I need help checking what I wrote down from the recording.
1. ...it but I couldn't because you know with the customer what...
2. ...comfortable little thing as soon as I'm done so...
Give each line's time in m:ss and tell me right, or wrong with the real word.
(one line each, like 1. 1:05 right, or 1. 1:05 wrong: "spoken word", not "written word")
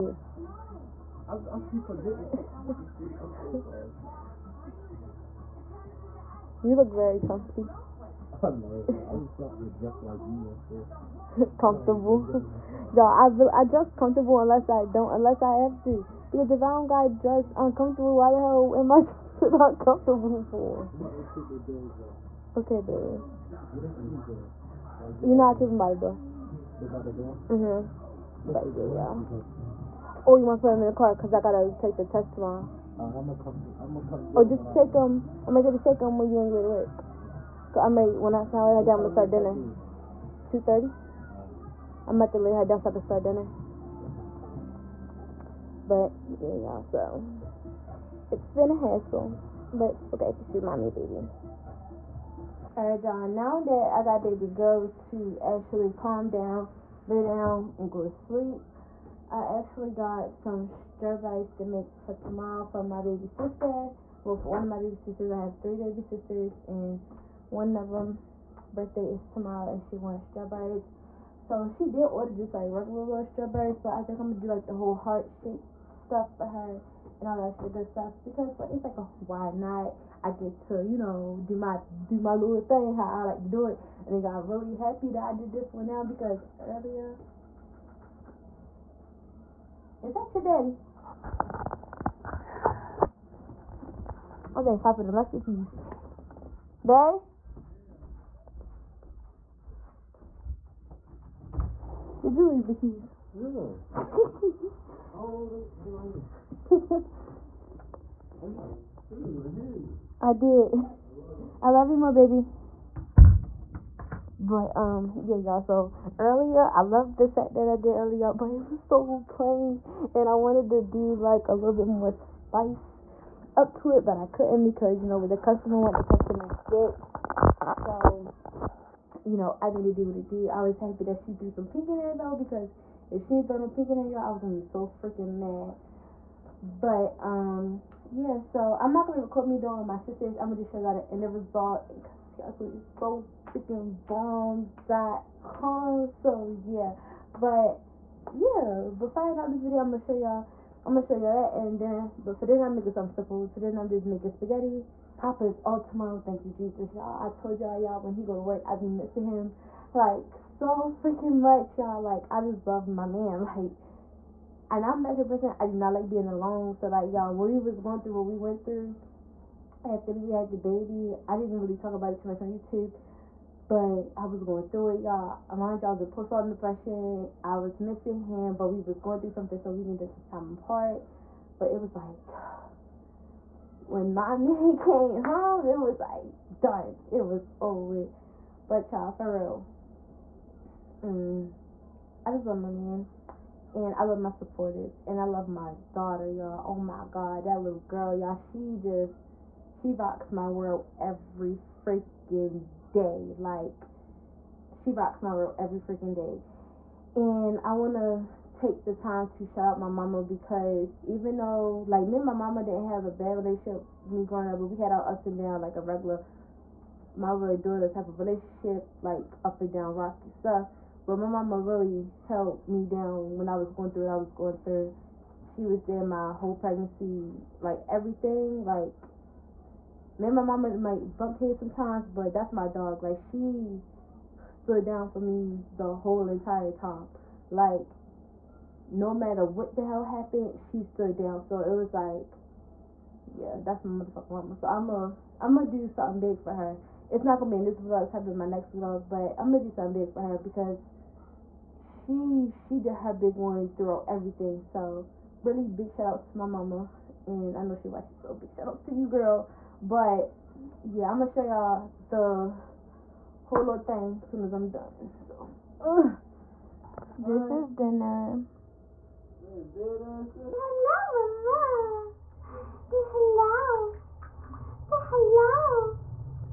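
1. 2:03 right
2. 4:23 wrong: "whole", not "comfortable".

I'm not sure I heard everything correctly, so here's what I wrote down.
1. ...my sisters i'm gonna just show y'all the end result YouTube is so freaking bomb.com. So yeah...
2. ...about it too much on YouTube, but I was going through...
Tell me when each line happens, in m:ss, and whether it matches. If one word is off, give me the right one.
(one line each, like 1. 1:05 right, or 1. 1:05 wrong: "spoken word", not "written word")
1. 2:19 wrong: "Castle", not "YouTube"
2. 2:51 right.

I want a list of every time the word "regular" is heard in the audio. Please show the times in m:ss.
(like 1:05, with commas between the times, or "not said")
1:12, 3:35.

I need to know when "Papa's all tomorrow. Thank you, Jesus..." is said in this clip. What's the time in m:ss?
2:35.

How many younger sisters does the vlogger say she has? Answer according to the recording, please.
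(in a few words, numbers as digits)
3.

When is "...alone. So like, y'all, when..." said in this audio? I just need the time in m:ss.
2:46.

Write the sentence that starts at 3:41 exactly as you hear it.
But my mama really held me down when I was going through what I was going through.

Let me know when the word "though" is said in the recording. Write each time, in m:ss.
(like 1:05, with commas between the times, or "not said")
2:12, 3:31.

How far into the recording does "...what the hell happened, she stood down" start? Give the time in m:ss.
3:59.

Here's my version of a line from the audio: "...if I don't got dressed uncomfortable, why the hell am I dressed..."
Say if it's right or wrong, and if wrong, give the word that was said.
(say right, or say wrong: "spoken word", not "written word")
right.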